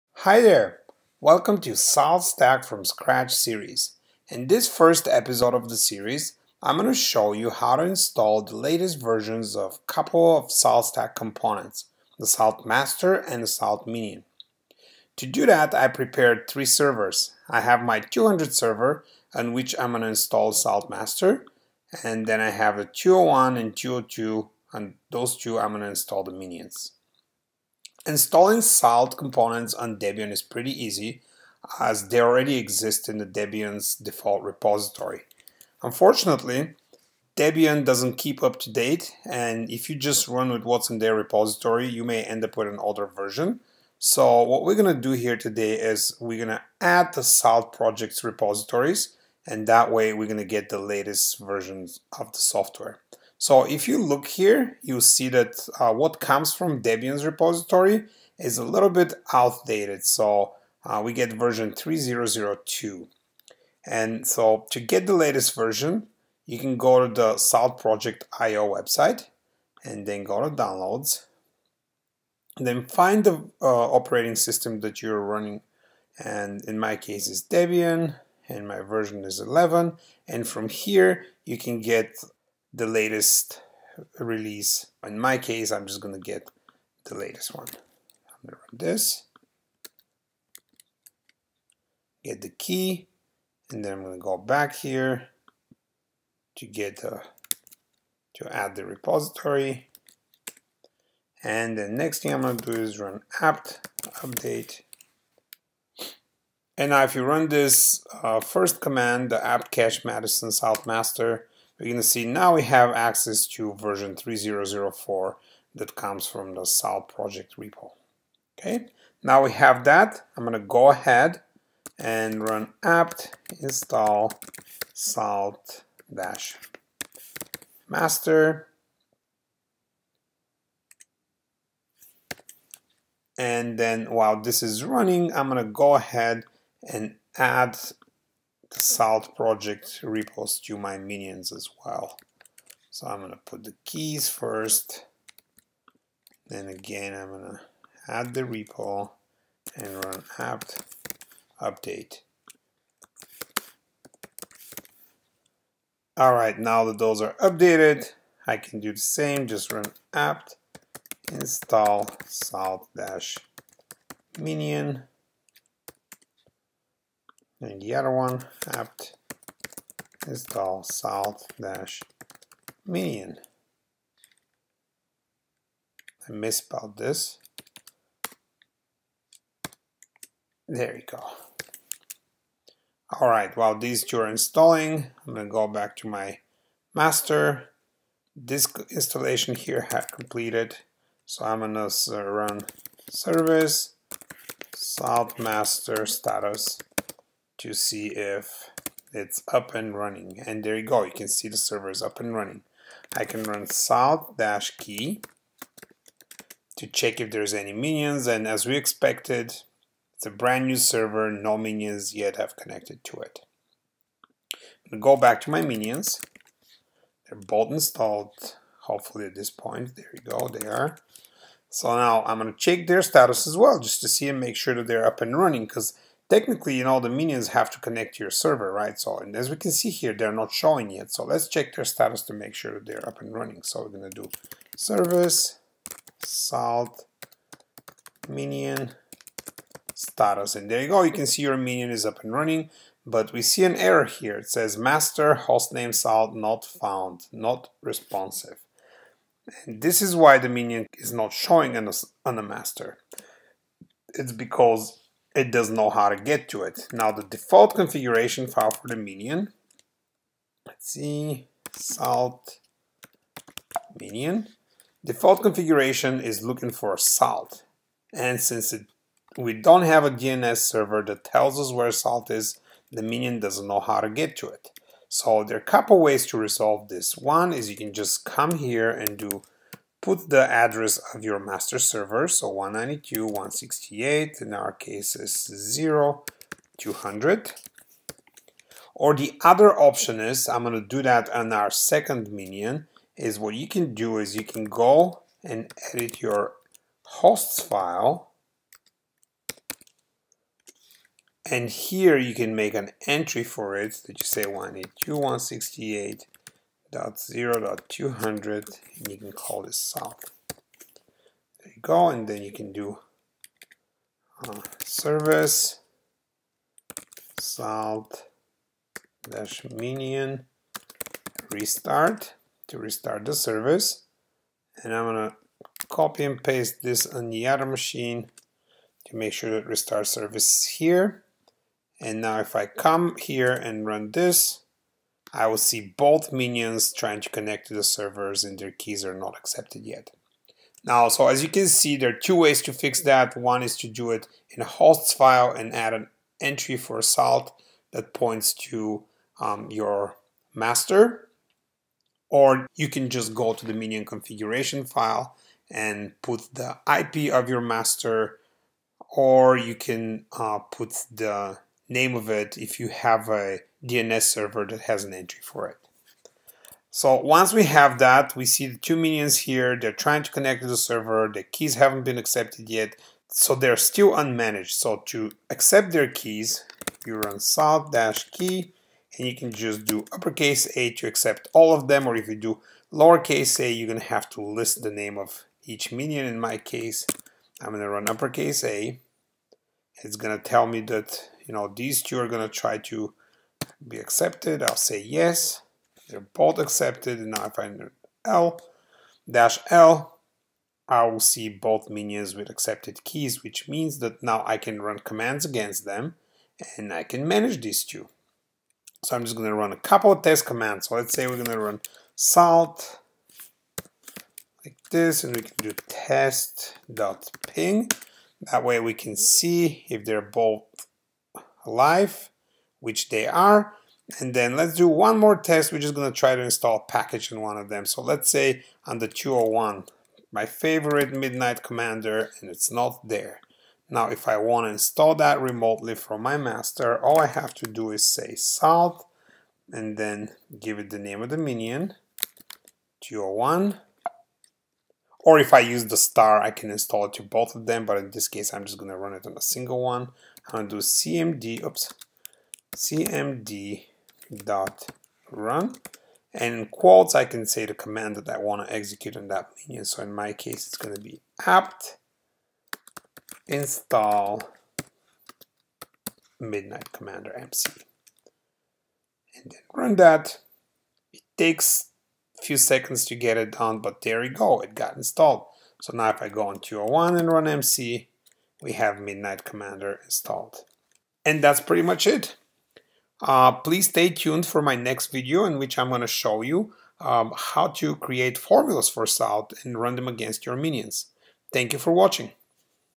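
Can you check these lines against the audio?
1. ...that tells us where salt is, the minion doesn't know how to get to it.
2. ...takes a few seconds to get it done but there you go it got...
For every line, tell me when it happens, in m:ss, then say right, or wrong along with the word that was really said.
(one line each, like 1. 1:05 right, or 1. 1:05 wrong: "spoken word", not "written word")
1. 4:31 right
2. 7:51 right.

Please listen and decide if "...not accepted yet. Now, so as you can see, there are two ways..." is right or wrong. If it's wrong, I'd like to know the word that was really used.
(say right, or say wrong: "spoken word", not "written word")
right.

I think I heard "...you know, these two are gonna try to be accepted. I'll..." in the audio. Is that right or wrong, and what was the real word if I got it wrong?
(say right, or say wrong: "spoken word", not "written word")
right.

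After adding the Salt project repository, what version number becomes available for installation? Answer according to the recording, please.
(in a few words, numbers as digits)
3004.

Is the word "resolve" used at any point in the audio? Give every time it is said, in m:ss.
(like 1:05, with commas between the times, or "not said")
4:36.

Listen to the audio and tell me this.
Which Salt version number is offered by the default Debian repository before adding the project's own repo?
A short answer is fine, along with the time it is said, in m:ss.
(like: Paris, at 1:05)
3002, at 1:01.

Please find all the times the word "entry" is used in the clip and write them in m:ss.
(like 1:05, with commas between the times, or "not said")
5:03, 5:46, 6:05.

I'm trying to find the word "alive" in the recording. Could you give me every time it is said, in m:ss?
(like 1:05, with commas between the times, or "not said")
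7:01.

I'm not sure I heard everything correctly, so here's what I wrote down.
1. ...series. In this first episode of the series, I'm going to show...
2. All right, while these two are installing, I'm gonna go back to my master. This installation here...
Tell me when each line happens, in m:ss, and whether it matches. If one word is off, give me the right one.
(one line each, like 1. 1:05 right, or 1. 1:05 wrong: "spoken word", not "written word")
1. 0:03 right
2. 3:03 right.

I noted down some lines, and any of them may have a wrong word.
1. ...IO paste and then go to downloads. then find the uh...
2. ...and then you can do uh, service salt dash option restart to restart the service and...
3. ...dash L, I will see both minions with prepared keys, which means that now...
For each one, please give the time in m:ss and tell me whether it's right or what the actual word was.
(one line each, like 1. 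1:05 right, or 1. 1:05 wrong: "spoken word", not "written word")
1. 1:08 wrong: "website", not "paste"
2. 5:12 wrong: "minion", not "option"
3. 6:39 wrong: "accepted", not "prepared".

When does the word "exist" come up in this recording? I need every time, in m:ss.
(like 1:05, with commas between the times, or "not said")
0:32.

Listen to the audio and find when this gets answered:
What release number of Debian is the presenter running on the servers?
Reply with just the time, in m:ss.
1:19.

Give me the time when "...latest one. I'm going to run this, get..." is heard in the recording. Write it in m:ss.
1:27.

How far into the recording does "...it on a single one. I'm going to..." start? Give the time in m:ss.
7:29.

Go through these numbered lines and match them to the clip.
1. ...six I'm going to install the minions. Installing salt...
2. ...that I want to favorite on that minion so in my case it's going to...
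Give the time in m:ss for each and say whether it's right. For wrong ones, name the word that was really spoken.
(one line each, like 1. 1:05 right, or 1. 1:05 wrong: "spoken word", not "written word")
1. 0:25 wrong: "two", not "six"
2. 7:38 wrong: "execute", not "favorite".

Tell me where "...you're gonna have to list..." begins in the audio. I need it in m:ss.
6:23.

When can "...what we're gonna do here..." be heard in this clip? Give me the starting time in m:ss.
0:44.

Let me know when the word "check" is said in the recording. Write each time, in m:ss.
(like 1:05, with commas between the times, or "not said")
3:26, 3:42, 3:51.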